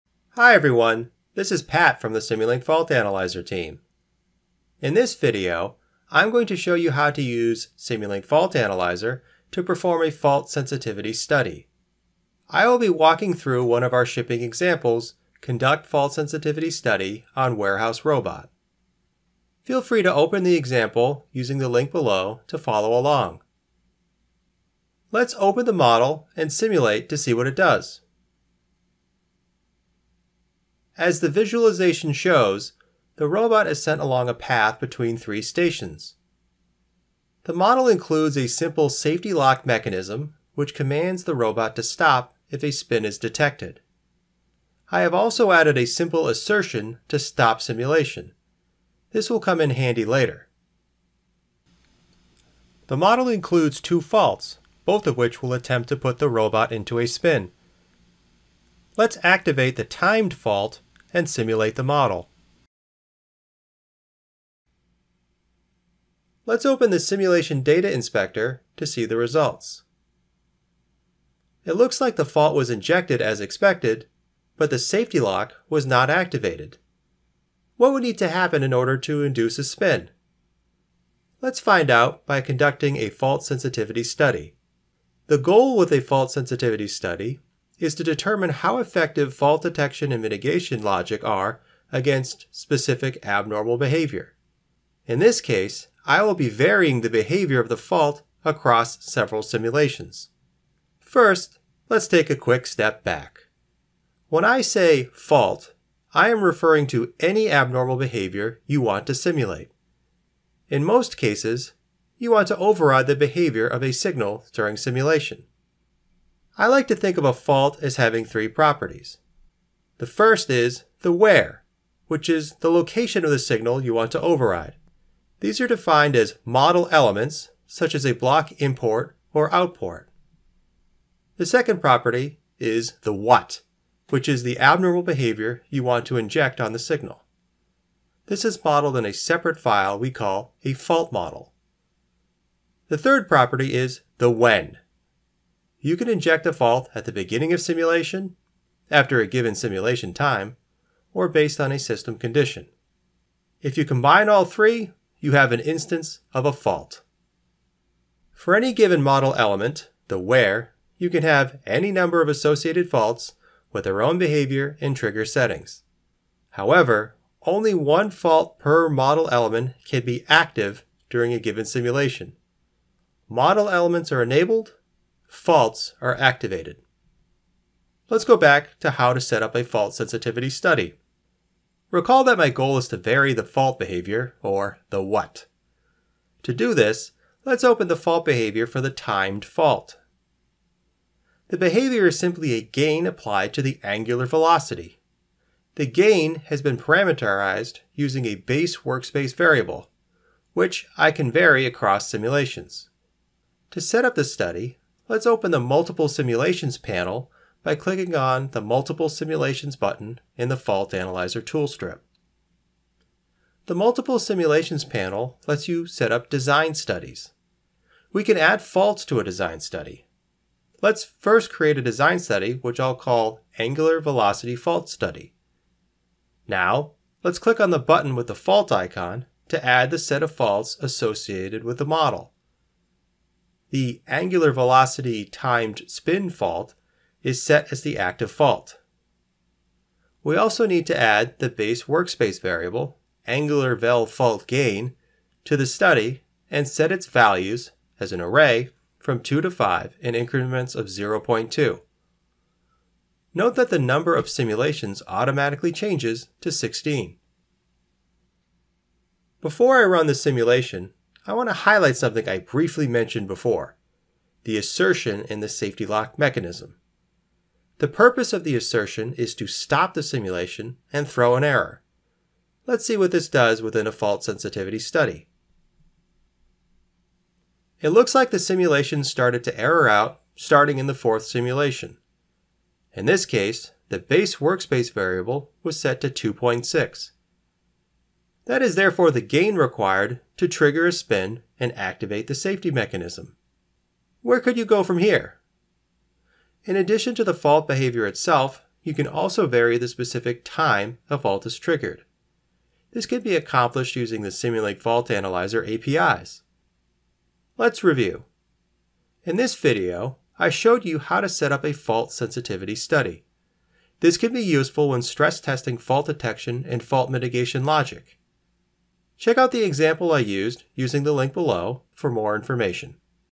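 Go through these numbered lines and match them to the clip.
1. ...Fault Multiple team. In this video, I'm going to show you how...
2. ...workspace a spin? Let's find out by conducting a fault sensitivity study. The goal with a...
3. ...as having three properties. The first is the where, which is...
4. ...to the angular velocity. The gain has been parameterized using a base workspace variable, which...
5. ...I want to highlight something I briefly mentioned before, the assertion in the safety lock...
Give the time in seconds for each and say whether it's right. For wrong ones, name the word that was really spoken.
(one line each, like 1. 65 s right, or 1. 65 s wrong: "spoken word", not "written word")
1. 2 s wrong: "Analyzer", not "Multiple"
2. 79 s wrong: "induce", not "workspace"
3. 117 s right
4. 193 s right
5. 261 s right.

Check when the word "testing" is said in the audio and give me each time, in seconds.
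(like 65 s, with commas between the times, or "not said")
315 s.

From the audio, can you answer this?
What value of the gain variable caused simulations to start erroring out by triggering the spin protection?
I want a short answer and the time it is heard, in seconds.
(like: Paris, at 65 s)
2.6, at 286 s.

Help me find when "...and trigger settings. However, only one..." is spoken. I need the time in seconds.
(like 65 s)
164 s.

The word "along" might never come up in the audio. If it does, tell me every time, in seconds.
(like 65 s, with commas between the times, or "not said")
22 s, 34 s.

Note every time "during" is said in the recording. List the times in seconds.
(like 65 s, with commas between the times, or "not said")
114 s, 171 s.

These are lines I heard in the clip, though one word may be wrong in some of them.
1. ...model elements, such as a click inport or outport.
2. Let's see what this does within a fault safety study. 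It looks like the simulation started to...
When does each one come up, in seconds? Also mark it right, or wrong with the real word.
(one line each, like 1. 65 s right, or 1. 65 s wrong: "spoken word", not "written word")
1. 126 s wrong: "block", not "click"
2. 272 s wrong: "sensitivity", not "safety".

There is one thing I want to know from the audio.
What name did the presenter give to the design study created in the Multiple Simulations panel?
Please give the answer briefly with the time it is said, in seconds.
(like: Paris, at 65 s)
Angular Velocity Fault Study, at 223 s.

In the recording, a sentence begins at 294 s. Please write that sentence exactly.
Where could you go from here?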